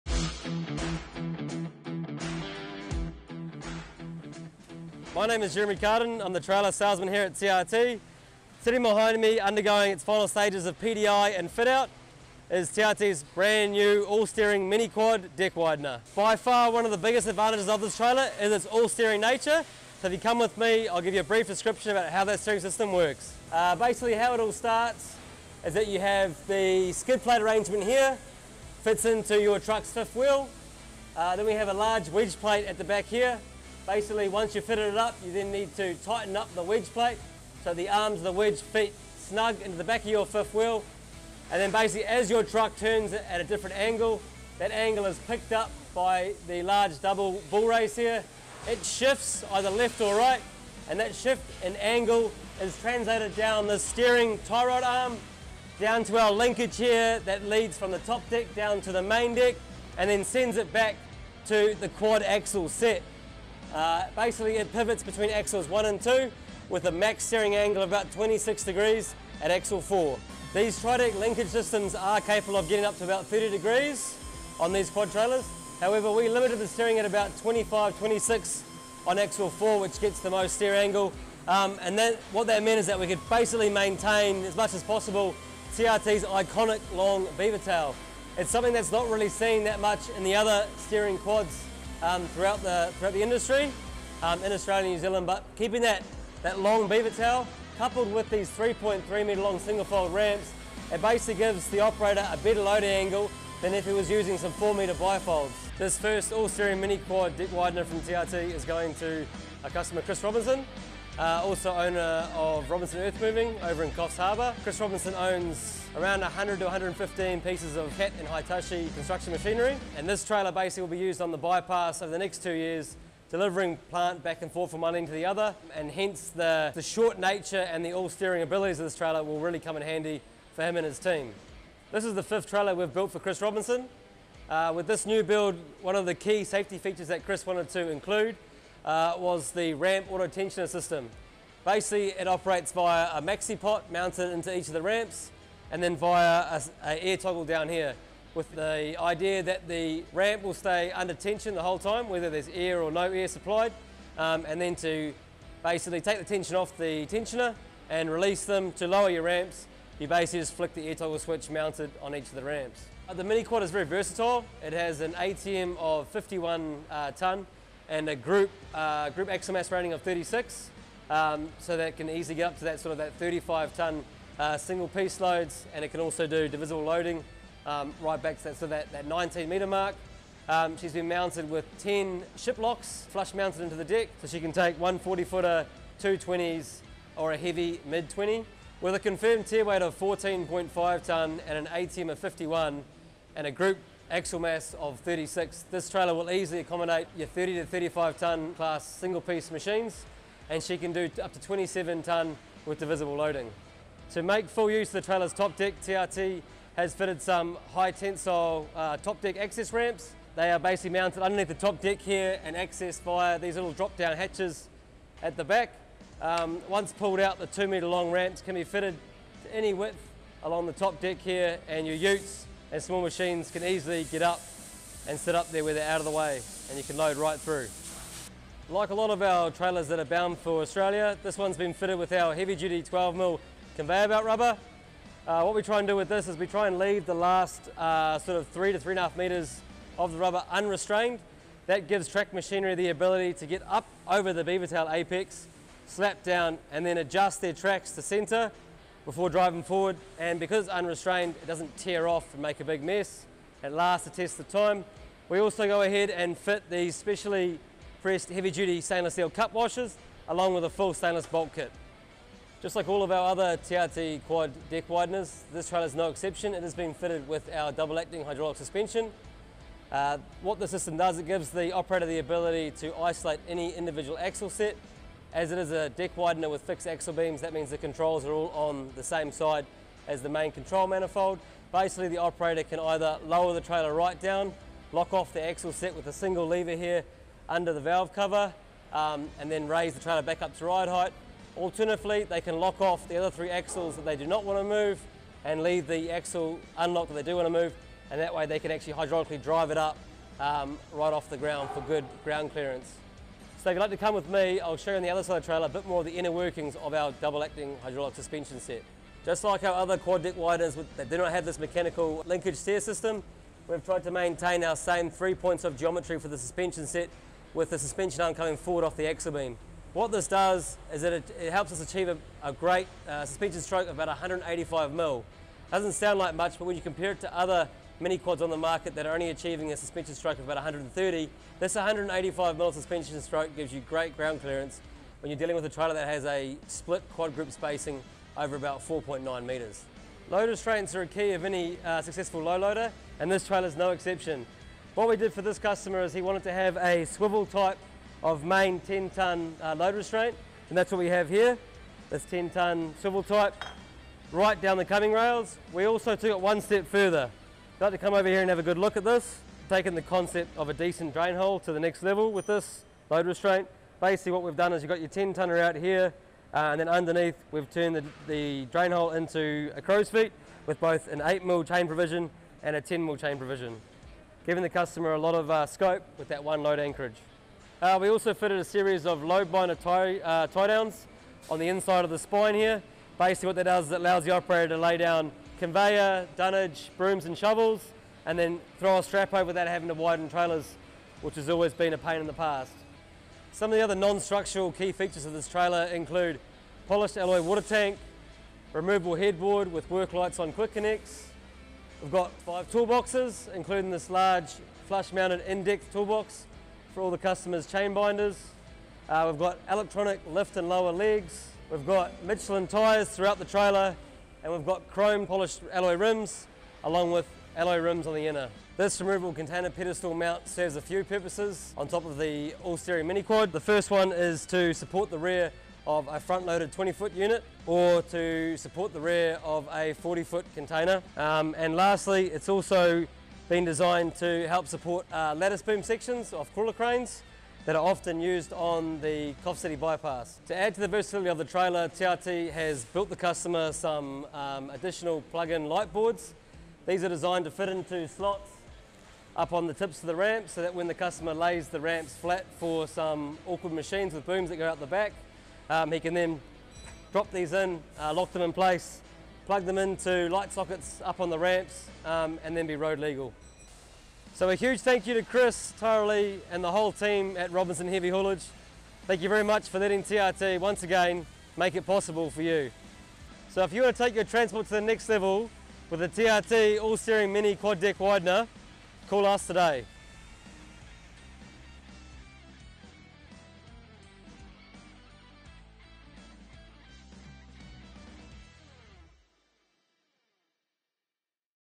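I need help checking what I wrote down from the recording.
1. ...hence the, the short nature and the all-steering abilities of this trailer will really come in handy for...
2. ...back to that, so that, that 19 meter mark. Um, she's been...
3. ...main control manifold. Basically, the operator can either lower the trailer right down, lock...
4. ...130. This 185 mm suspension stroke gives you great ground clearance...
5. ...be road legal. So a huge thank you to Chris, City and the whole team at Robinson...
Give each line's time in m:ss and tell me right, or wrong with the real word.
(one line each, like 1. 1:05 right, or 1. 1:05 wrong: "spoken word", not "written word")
1. 2:05 right
2. 2:58 right
3. 4:40 right
4. 5:30 right
5. 7:42 wrong: "Lee", not "City".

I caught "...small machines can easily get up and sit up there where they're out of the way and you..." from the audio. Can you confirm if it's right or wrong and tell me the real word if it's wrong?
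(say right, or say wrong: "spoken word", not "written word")
right.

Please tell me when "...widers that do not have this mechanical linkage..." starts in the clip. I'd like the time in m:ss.
5:10.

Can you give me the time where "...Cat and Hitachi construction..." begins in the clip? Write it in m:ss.
1:57.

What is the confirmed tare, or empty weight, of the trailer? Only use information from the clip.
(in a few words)
14.5 tonne.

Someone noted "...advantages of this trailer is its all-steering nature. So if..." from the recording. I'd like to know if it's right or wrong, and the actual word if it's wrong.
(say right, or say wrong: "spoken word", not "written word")
right.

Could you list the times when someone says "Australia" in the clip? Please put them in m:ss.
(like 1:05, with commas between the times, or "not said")
1:34, 3:50.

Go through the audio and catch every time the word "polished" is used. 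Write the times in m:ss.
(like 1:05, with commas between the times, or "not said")
6:36, 6:55.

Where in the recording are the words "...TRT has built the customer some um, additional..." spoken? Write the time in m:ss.
7:21.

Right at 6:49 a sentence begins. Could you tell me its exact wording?
Uh, we've got electronic lift and lower legs.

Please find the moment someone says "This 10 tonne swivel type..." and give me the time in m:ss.
5:52.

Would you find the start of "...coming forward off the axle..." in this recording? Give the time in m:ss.
5:18.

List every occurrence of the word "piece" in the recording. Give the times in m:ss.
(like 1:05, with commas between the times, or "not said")
1:57, 2:54, 3:19.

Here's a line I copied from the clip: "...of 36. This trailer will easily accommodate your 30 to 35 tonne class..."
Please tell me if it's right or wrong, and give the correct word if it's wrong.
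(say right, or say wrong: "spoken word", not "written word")
right.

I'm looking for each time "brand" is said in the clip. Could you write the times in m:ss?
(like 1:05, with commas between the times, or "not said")
0:13.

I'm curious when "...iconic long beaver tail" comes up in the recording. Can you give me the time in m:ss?
1:26.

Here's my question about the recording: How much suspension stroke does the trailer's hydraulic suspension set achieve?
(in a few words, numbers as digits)
185 mm.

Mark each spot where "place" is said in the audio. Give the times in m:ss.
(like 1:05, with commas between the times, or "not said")
7:38.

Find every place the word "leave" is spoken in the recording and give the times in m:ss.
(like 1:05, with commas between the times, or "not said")
3:56, 4:55.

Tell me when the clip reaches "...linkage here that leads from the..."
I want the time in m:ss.
0:56.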